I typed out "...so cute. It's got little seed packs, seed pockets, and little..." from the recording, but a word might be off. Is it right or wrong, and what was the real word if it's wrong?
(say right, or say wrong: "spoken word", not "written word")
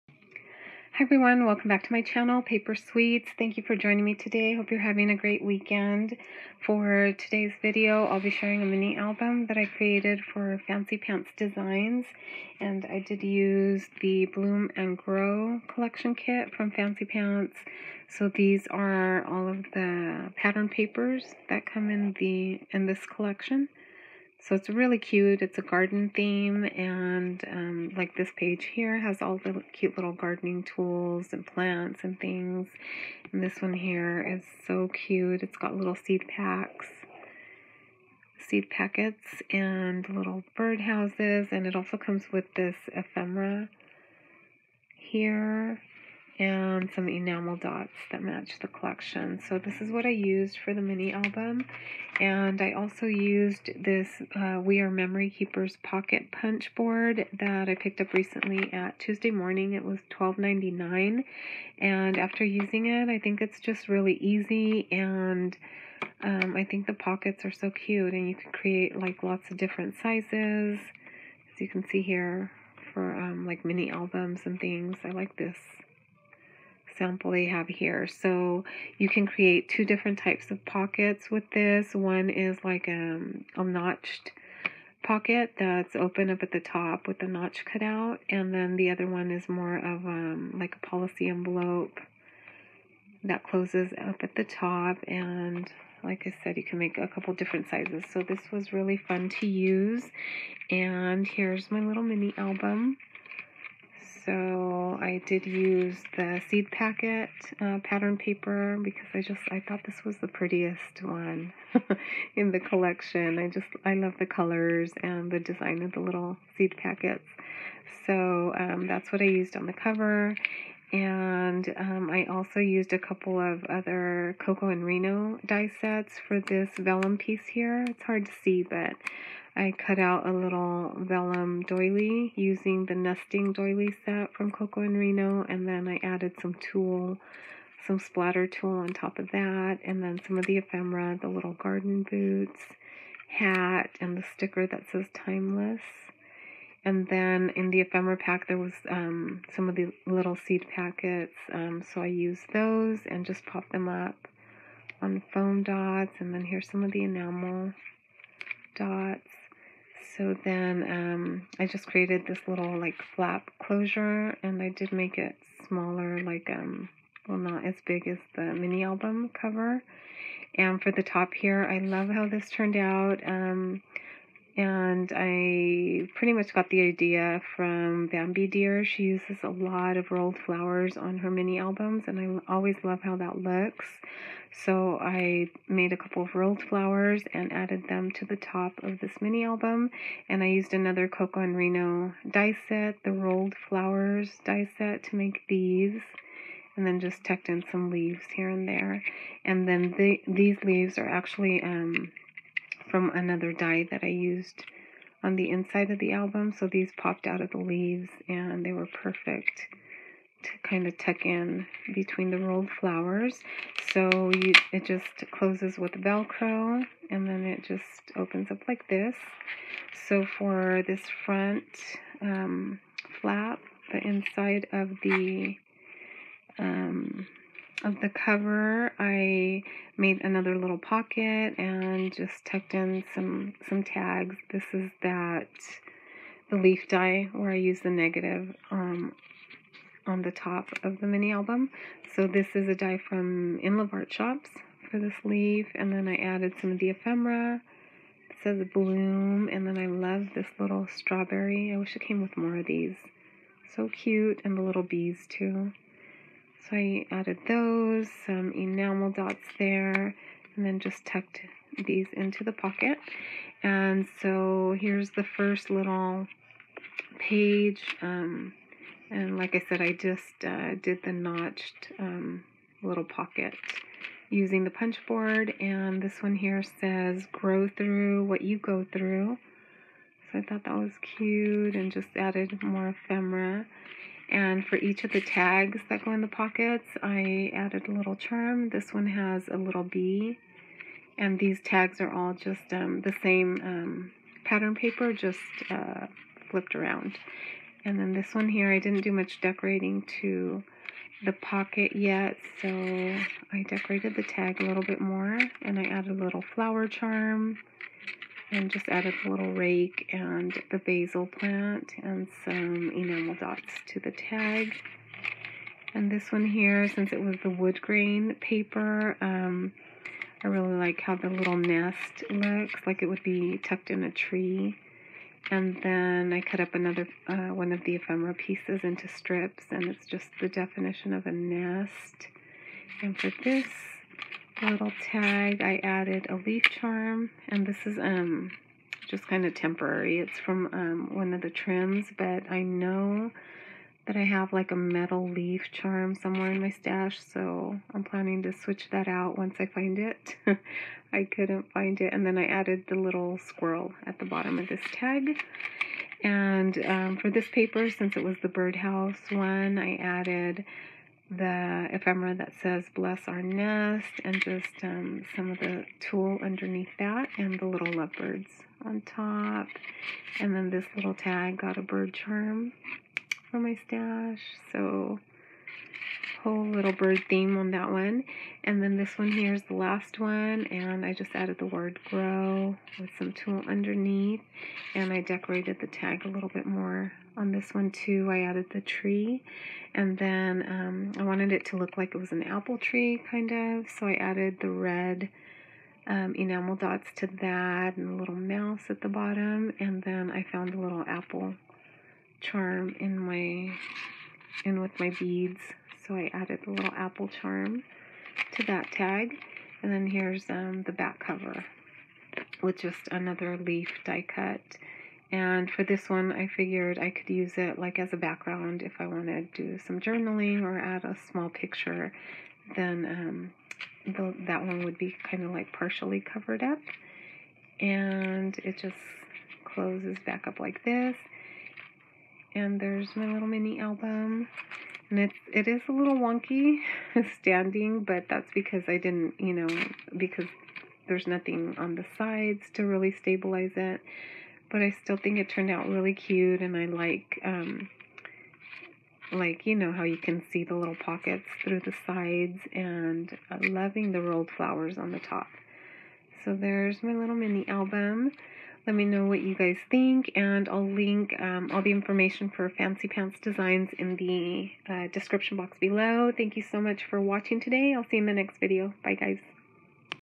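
wrong: "packets", not "pockets".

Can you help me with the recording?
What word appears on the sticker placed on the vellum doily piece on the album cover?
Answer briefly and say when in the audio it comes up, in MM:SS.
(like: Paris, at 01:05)
timeless, at 02:25.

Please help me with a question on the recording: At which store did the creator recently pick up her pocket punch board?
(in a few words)
Tuesday Morning.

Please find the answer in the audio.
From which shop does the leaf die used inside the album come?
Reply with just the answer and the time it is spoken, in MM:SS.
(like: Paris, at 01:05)
In Love Art Shops, at 04:03.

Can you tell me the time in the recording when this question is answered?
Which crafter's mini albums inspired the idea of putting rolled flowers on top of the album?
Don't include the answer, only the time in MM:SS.
02:58.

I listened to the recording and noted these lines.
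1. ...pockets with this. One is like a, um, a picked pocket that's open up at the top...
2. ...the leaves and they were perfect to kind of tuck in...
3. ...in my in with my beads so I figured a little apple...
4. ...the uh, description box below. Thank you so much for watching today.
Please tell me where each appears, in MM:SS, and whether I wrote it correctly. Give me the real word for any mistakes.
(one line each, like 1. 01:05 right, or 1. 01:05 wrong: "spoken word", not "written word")
1. 01:20 wrong: "notched", not "picked"
2. 03:27 right
3. 06:42 wrong: "added", not "figured"
4. 07:44 right.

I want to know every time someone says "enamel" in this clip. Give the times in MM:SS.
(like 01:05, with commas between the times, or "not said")
00:47, 02:37, 04:18, 05:12, 06:36.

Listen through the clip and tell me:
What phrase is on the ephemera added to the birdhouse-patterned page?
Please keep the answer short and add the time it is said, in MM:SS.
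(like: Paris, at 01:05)
bless our nest, at 06:02.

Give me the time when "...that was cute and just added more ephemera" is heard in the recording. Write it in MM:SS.
04:40.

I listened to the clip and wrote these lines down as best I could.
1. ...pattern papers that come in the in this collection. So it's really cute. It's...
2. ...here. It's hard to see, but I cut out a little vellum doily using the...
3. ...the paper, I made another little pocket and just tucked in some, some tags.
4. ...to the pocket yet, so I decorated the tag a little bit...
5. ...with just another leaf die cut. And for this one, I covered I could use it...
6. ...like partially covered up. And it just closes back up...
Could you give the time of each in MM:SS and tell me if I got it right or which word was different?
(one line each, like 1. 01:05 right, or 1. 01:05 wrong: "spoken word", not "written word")
1. 00:20 right
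2. 02:07 right
3. 03:48 wrong: "cover", not "paper"
4. 05:00 right
5. 06:52 wrong: "figured", not "covered"
6. 07:05 right.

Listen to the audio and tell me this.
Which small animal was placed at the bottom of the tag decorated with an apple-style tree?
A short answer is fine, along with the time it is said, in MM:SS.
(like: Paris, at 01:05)
mouse, at 06:38.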